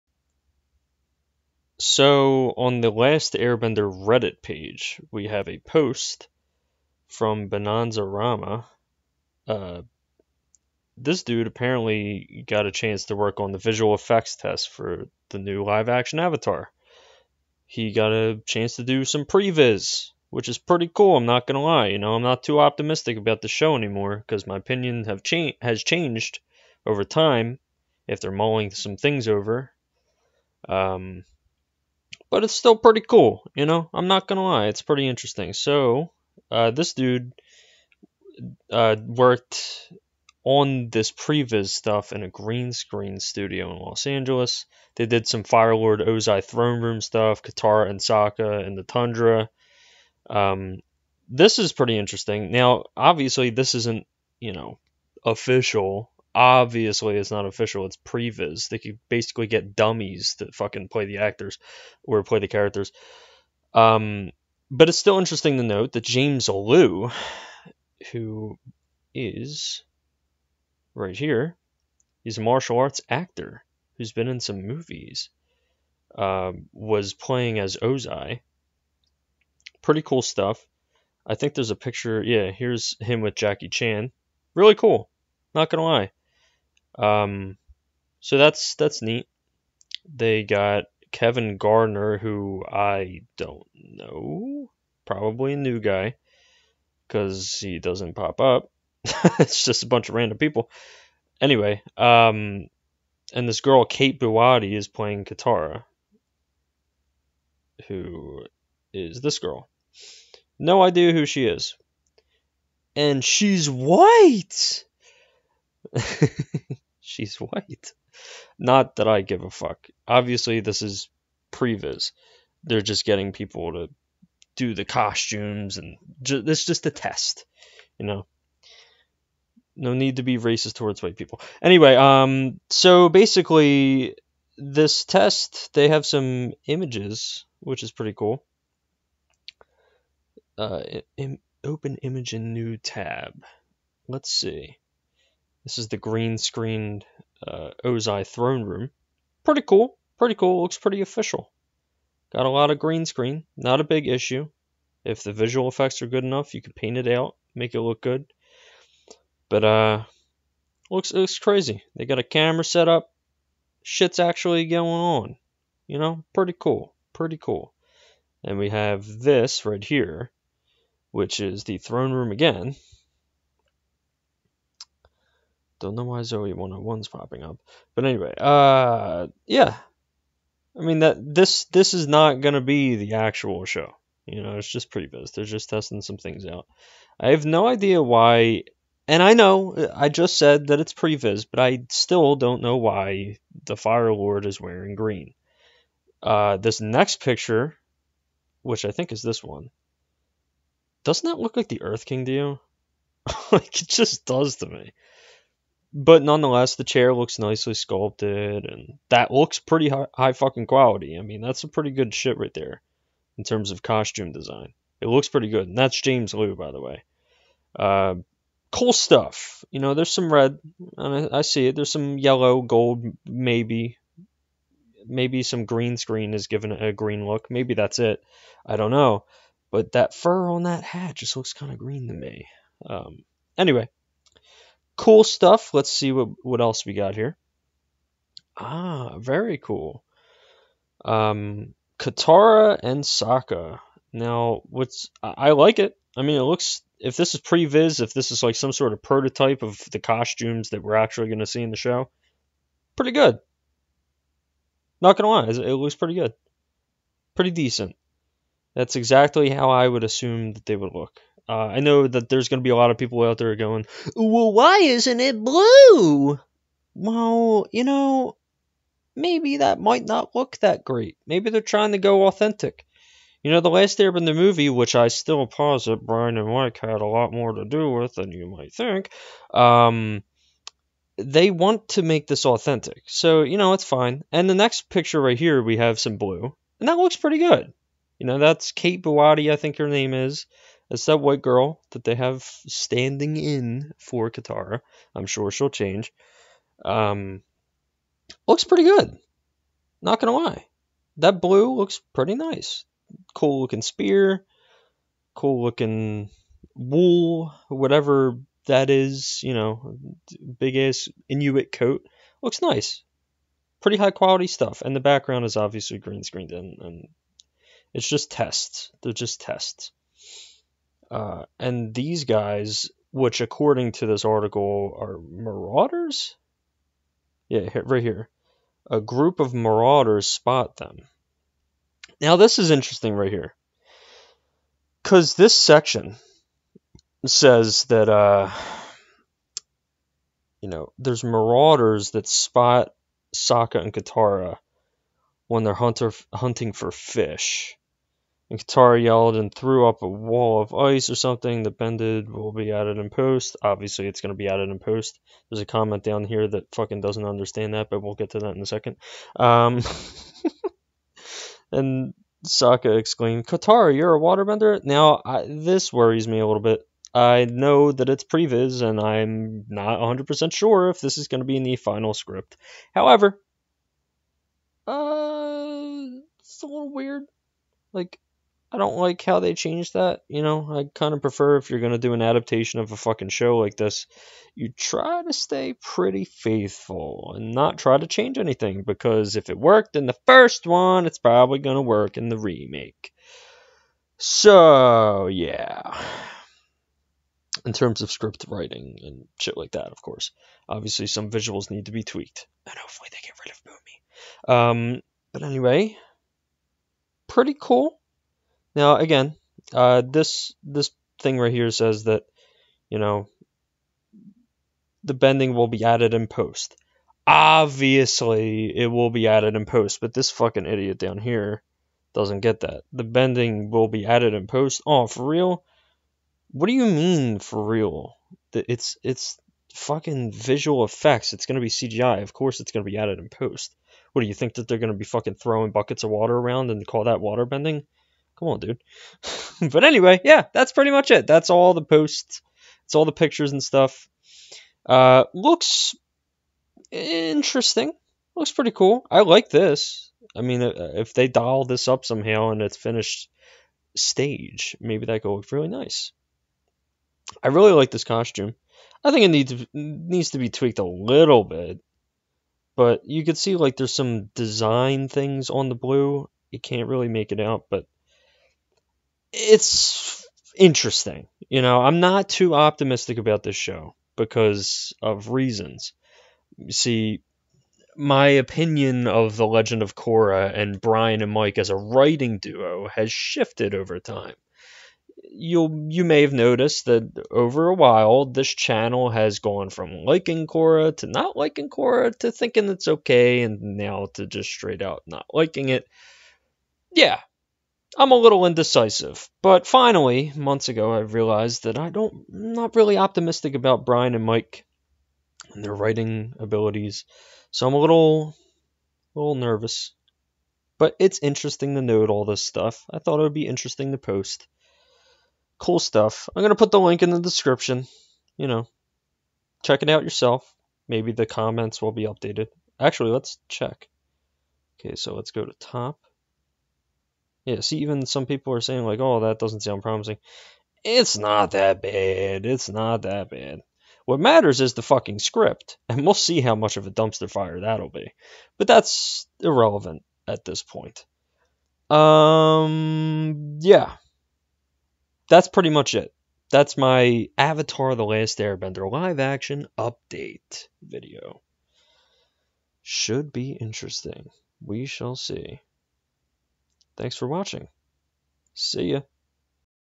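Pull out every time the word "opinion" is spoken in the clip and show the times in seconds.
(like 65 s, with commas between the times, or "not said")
24 s, 478 s.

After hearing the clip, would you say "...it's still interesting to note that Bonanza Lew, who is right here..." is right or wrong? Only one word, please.
wrong.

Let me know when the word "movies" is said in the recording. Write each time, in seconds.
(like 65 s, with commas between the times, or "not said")
74 s, 274 s.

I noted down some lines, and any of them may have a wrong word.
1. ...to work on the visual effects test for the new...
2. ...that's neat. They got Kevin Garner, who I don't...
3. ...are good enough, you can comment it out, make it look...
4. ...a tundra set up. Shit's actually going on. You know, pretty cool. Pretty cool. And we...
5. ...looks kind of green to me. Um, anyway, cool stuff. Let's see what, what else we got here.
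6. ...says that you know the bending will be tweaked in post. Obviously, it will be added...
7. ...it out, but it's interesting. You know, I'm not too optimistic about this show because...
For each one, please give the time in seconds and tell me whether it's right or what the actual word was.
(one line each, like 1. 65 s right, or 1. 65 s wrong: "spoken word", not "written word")
1. 13 s right
2. 88 s right
3. 156 s wrong: "paint", not "comment"
4. 162 s wrong: "camera", not "tundra"
5. 231 s right
6. 411 s wrong: "added", not "tweaked"
7. 467 s right.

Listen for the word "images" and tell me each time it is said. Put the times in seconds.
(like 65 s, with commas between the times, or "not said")
136 s, 142 s.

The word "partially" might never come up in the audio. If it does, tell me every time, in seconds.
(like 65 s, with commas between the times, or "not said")
not said.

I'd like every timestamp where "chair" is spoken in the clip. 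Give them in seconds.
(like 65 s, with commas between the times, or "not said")
206 s.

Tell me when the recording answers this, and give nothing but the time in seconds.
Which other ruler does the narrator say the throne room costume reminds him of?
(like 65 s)
201 s.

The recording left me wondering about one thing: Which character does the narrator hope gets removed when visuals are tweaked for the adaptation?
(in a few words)
Boomy.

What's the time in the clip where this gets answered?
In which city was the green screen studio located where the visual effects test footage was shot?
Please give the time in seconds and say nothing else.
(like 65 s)
43 s.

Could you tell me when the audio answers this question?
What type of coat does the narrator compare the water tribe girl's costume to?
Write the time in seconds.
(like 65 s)
311 s.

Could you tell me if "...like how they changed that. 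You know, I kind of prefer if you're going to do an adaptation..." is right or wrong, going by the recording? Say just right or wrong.
right.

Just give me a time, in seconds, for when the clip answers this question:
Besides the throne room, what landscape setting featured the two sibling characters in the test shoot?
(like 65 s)
48 s.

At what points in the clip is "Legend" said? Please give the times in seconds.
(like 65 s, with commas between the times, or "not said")
479 s.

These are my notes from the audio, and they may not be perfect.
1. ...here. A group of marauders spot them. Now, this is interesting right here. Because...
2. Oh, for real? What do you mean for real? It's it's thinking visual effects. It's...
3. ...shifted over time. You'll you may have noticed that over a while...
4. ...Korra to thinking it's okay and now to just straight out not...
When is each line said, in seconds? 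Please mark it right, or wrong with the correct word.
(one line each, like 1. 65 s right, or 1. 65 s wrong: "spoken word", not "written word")
1. 328 s right
2. 424 s wrong: "fucking", not "thinking"
3. 483 s right
4. 491 s right.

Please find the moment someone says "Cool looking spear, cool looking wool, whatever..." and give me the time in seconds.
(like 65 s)
303 s.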